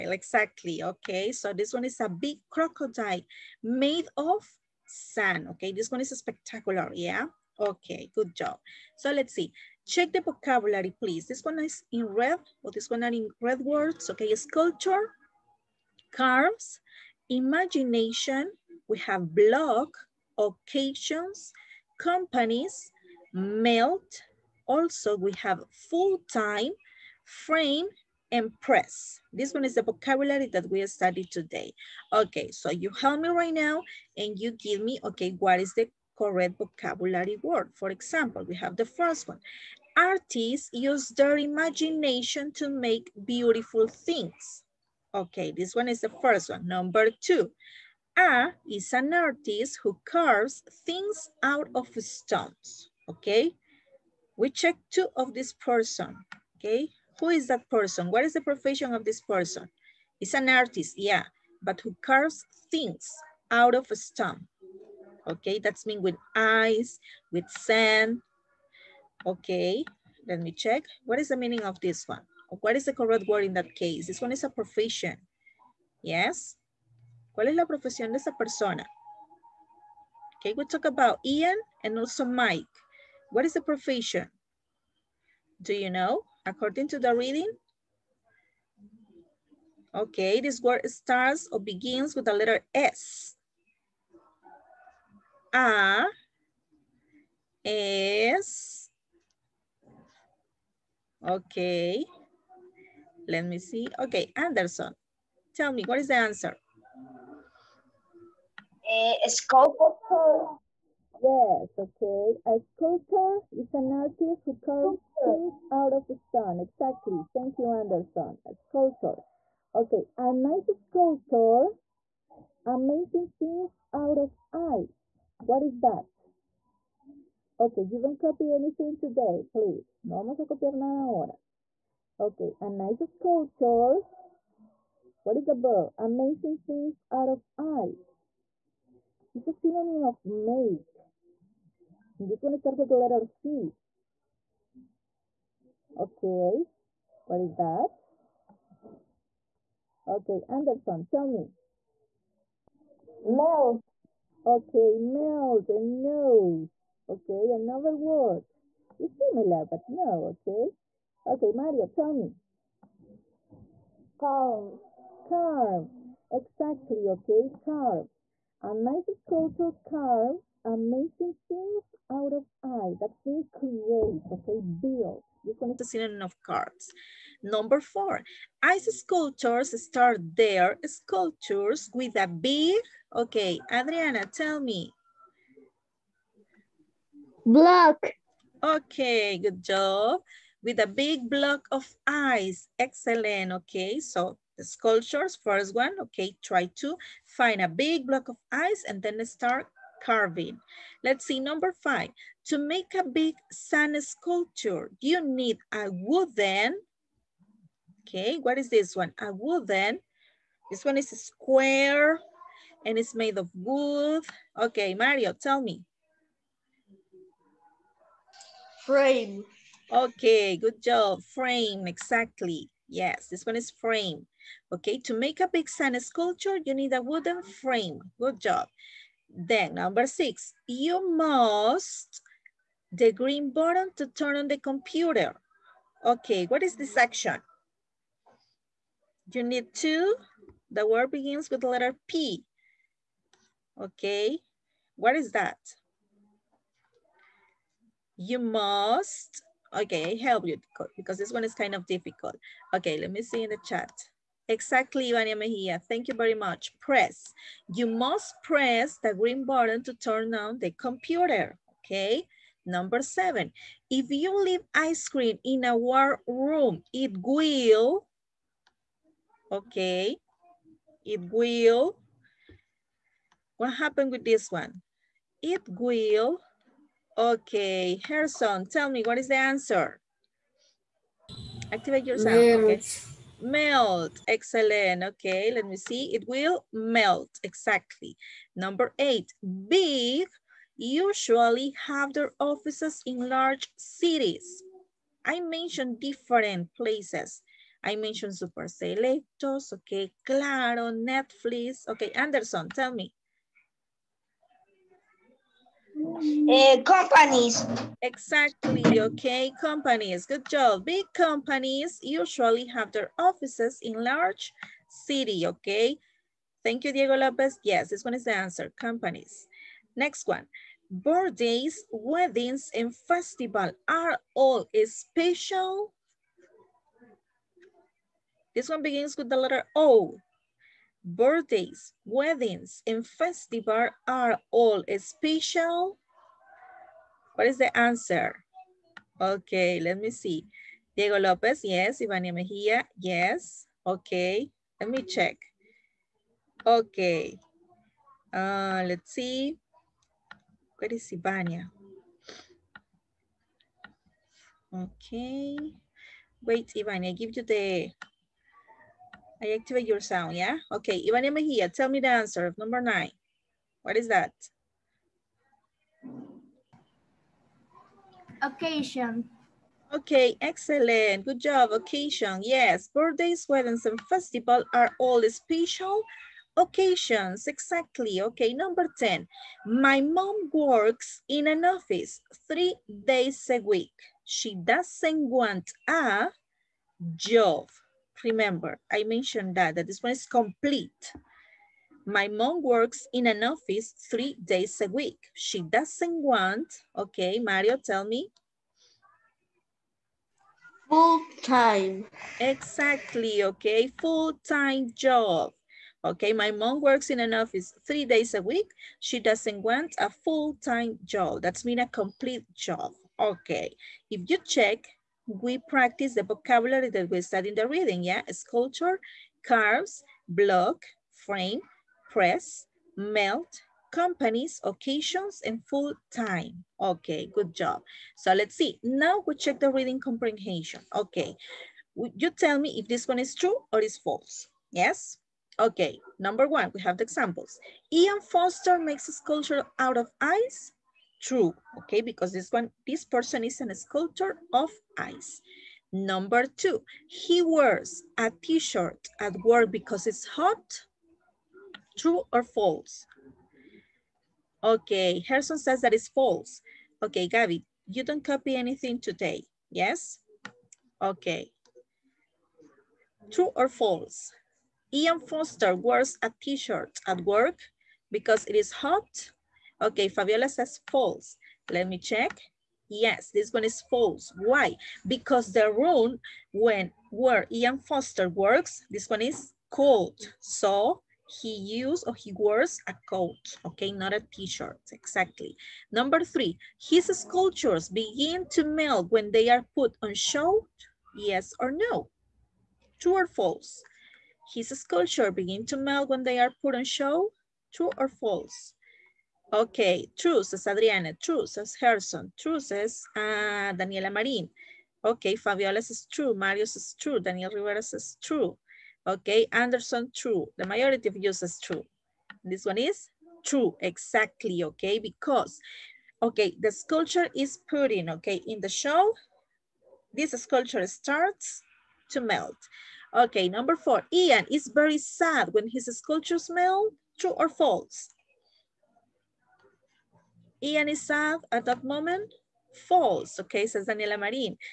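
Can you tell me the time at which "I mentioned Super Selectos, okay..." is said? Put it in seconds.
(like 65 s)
297 s.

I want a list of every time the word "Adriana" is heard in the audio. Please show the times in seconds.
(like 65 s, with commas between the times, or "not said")
183 s, 500 s.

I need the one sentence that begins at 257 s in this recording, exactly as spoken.
You must press the green button to turn on the computer, okay?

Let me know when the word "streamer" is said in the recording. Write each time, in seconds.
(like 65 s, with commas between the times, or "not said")
not said.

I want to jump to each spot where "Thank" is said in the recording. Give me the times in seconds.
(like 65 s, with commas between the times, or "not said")
117 s, 255 s, 316 s.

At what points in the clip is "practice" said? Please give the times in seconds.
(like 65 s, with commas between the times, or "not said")
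415 s.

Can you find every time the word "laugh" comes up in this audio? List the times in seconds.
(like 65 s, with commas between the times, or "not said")
not said.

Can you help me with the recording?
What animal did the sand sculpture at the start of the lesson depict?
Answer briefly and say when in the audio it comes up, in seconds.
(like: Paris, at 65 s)
Crocodile, at 2 s.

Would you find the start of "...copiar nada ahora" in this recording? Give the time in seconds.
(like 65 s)
130 s.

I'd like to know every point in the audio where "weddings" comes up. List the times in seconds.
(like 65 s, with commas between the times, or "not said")
321 s, 332 s, 373 s.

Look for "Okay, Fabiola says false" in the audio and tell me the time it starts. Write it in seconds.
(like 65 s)
469 s.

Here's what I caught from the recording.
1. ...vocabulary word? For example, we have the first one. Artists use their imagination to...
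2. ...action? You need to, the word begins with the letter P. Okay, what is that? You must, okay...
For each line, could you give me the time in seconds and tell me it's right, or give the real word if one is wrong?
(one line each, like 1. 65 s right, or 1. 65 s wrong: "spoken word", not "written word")
1. 36 s right
2. 236 s right.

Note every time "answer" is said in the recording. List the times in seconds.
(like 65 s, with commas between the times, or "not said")
106 s, 279 s, 318 s, 337 s, 362 s.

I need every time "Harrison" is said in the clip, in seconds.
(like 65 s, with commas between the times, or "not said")
278 s, 455 s.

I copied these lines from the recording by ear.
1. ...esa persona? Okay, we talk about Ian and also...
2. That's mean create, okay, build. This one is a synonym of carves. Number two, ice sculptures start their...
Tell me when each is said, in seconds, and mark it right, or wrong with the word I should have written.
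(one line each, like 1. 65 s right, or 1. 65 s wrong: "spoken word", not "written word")
1. 78 s right
2. 172 s wrong: "four", not "two".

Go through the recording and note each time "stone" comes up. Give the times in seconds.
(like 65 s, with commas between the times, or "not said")
52 s, 63 s, 116 s.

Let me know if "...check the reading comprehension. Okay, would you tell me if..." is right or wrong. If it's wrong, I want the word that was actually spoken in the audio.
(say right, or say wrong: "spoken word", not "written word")
right.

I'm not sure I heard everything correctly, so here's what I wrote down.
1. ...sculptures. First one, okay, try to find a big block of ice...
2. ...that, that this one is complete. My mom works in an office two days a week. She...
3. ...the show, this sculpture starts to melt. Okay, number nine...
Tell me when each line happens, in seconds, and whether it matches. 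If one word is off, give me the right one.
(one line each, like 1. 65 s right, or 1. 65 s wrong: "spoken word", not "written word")
1. 194 s right
2. 389 s wrong: "three", not "two"
3. 518 s wrong: "four", not "nine".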